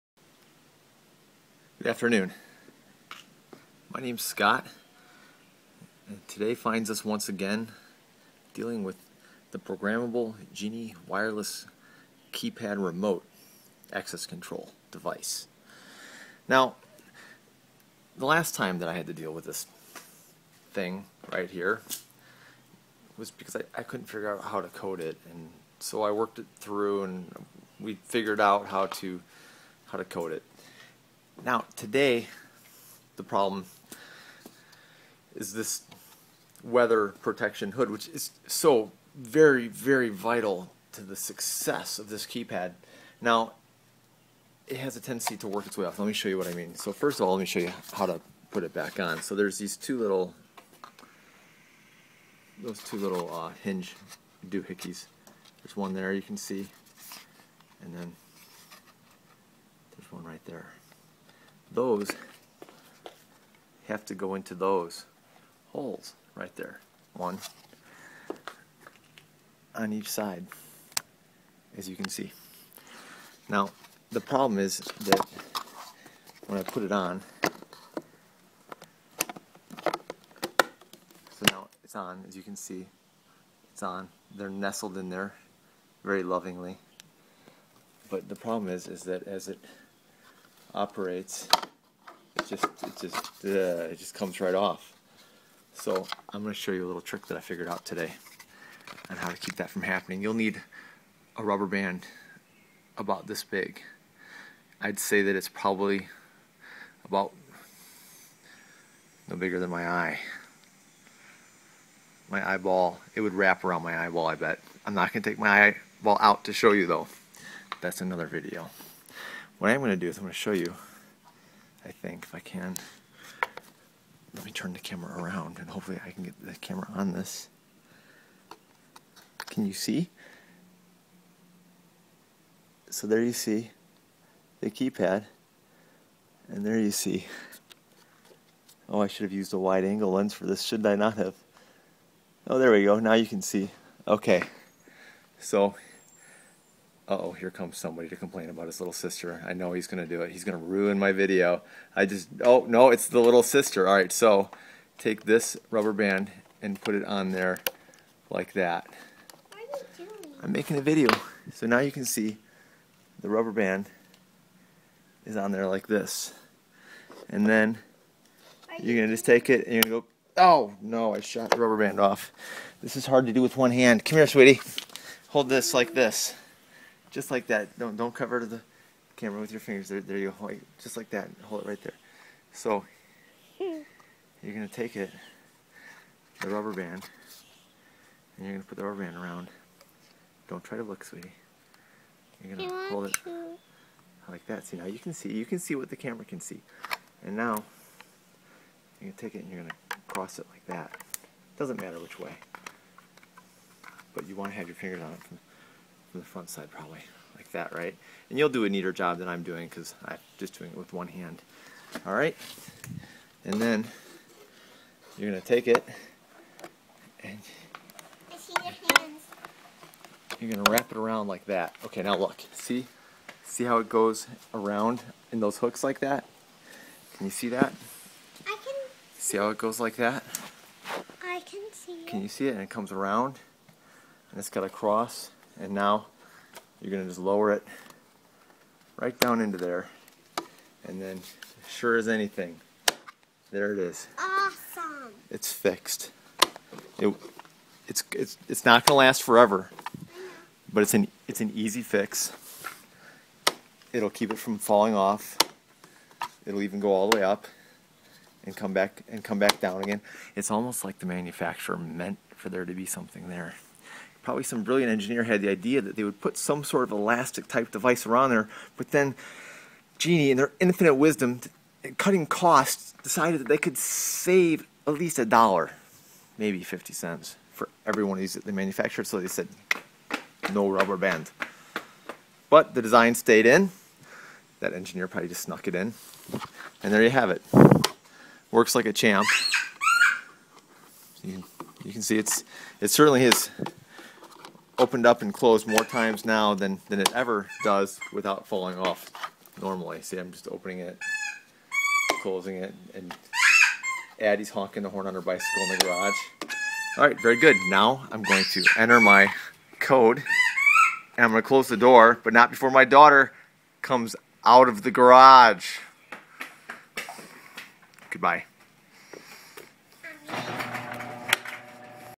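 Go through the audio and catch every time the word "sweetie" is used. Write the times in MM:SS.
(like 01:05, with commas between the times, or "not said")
02:54, 03:11.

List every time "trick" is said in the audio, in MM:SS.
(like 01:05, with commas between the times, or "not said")
01:37.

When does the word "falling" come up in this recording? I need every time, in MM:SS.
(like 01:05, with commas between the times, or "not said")
04:14, 04:58.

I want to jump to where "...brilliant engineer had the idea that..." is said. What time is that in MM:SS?
04:24.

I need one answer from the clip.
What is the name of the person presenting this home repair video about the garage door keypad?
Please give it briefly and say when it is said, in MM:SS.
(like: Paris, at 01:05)
Scott, at 00:04.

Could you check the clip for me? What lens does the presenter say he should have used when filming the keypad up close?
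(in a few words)
wide angle lens.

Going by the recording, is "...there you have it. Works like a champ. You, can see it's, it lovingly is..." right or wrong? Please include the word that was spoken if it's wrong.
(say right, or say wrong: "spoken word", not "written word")
wrong: "certainly", not "lovingly".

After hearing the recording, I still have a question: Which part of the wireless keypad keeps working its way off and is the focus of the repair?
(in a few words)
weather protection hood.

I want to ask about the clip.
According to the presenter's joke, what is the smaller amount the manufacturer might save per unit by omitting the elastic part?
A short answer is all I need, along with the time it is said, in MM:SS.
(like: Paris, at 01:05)
50 cents, at 04:36.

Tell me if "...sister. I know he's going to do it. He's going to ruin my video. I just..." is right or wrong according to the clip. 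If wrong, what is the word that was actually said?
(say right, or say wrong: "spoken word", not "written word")
right.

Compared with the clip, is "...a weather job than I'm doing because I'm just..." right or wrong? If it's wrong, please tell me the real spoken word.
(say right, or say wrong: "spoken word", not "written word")
wrong: "neater", not "weather".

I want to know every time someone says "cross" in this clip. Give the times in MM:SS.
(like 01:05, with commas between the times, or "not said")
03:20, 03:54.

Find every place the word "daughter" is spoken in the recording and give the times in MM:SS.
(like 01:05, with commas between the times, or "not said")
05:12.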